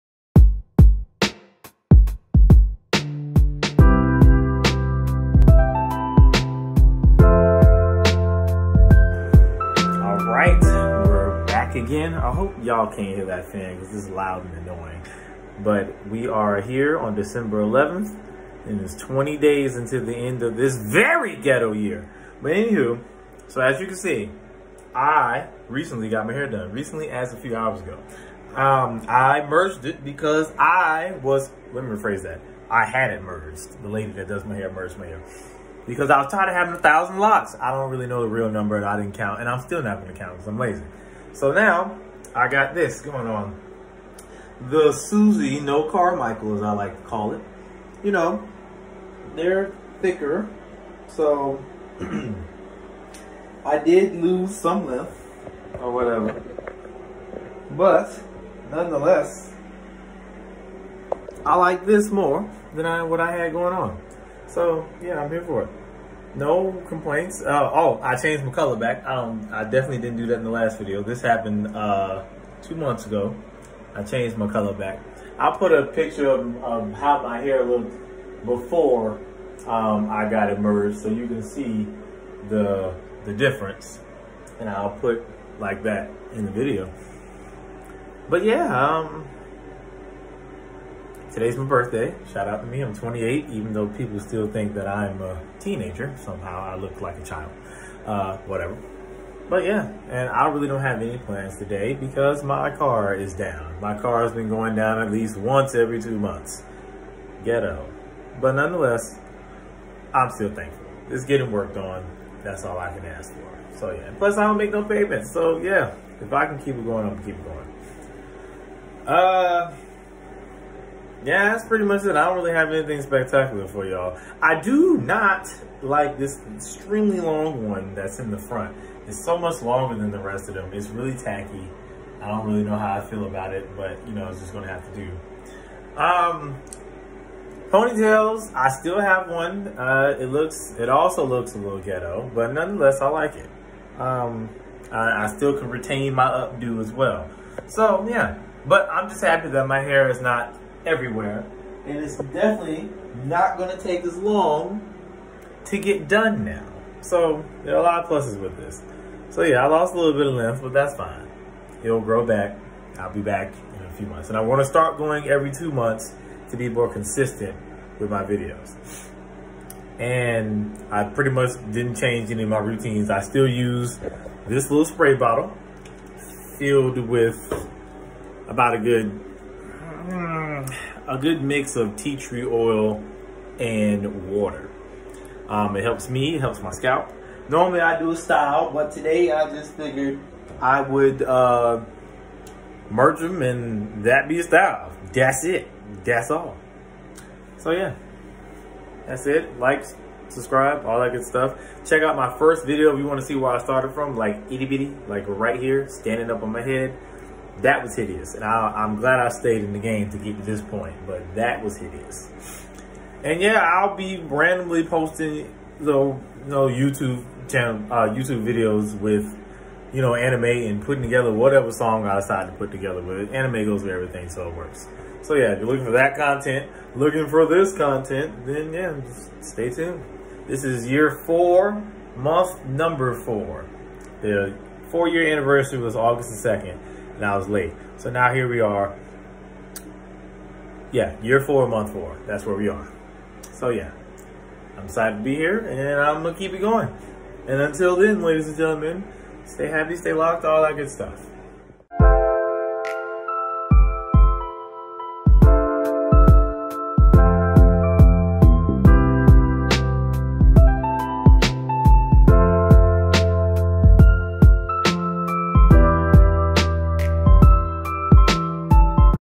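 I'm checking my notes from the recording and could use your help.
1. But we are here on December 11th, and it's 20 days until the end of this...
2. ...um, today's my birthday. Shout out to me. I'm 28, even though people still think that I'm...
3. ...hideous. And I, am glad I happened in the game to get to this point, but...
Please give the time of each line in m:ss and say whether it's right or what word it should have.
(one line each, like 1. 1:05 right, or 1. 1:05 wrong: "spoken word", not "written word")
1. 0:15 right
2. 1:28 right
3. 3:27 wrong: "stayed", not "happened".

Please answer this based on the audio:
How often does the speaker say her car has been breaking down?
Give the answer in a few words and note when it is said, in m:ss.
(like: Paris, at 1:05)
Once every two months, at 1:45.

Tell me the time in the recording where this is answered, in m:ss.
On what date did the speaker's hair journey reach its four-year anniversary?
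3:55.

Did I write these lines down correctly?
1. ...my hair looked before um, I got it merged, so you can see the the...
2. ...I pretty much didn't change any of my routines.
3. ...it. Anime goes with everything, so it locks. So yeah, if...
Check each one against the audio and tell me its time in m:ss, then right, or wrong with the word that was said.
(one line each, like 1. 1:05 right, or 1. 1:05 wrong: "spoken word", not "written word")
1. 1:17 right
2. 2:50 right
3. 3:43 wrong: "works", not "locks".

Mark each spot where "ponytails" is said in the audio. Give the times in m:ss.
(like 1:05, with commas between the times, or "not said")
2:17.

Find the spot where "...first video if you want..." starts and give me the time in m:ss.
3:22.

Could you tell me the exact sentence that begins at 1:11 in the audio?
This happened uh, two months ago.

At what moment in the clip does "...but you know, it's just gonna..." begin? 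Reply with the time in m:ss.
2:13.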